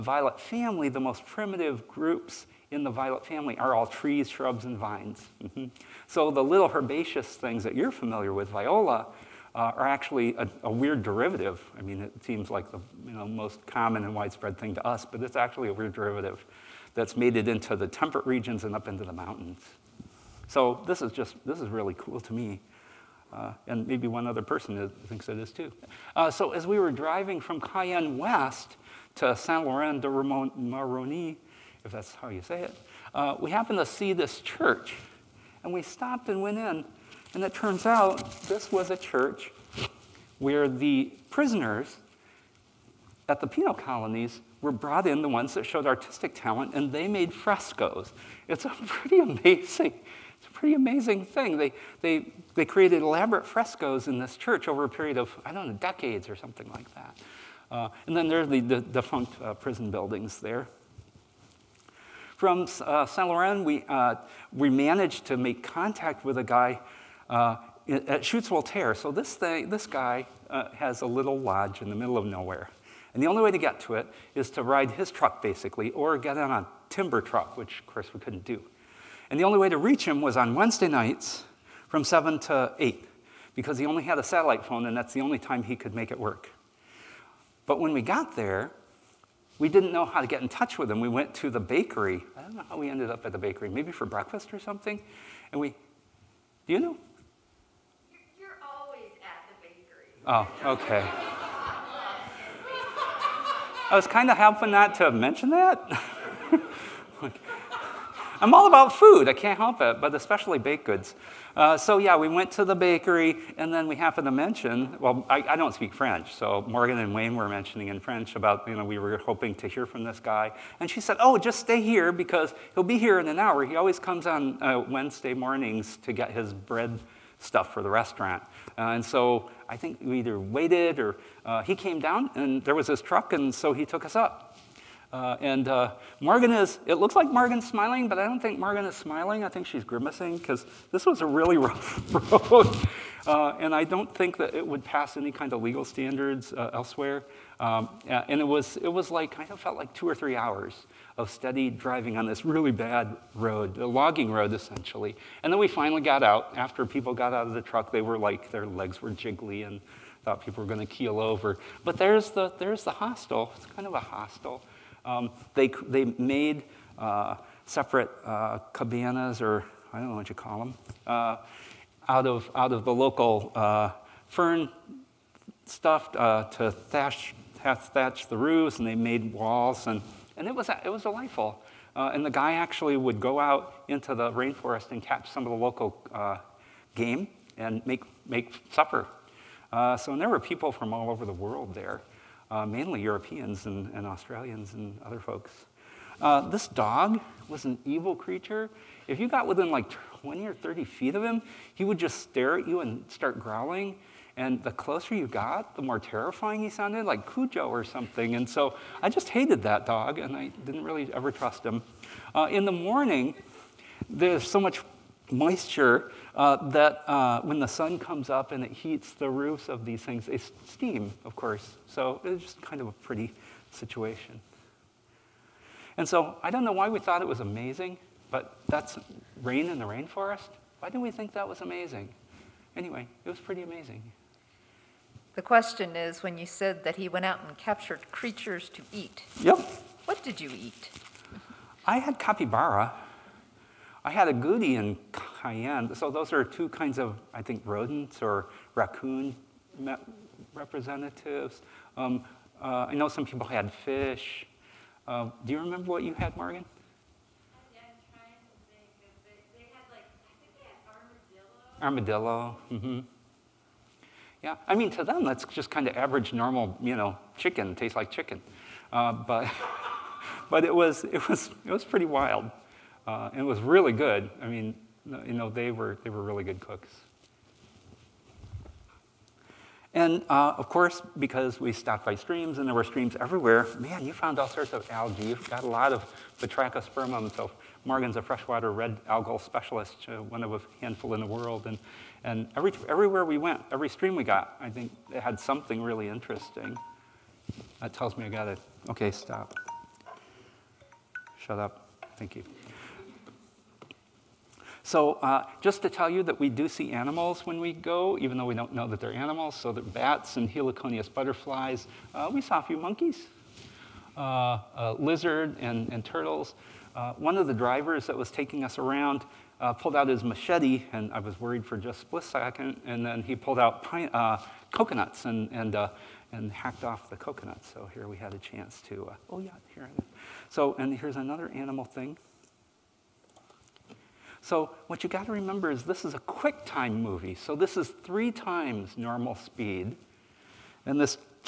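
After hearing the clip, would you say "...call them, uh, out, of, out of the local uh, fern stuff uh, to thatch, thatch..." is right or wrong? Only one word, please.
right.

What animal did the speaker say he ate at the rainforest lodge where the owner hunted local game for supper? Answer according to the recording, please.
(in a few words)
Capybara.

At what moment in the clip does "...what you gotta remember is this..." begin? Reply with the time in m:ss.
5:34.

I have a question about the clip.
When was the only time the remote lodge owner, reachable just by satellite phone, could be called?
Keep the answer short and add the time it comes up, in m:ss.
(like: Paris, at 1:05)
Wednesday nights, at 1:20.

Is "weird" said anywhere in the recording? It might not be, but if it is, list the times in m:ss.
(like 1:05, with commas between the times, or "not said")
0:10, 0:15.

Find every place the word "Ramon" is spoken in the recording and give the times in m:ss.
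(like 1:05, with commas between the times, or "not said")
0:30.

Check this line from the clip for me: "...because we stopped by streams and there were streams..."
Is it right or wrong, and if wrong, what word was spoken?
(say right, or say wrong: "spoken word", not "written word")
right.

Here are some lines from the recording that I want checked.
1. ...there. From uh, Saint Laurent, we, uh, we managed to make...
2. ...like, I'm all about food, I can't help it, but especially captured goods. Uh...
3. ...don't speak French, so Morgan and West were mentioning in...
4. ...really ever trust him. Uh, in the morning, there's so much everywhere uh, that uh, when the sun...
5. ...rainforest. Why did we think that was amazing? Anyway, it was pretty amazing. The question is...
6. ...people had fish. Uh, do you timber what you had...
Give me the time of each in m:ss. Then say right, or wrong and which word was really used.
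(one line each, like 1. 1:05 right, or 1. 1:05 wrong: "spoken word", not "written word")
1. 1:00 right
2. 1:47 wrong: "baked", not "captured"
3. 1:55 wrong: "Wayne", not "West"
4. 3:30 wrong: "moisture", not "everywhere"
5. 3:49 right
6. 4:13 wrong: "remember", not "timber".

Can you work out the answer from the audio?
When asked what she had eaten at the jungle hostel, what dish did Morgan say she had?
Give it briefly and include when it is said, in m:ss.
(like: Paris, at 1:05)
Armadillo, at 4:21.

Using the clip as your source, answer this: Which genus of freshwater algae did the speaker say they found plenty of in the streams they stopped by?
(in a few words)
Batrachospermum.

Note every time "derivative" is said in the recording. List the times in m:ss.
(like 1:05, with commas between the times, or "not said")
0:11, 0:15.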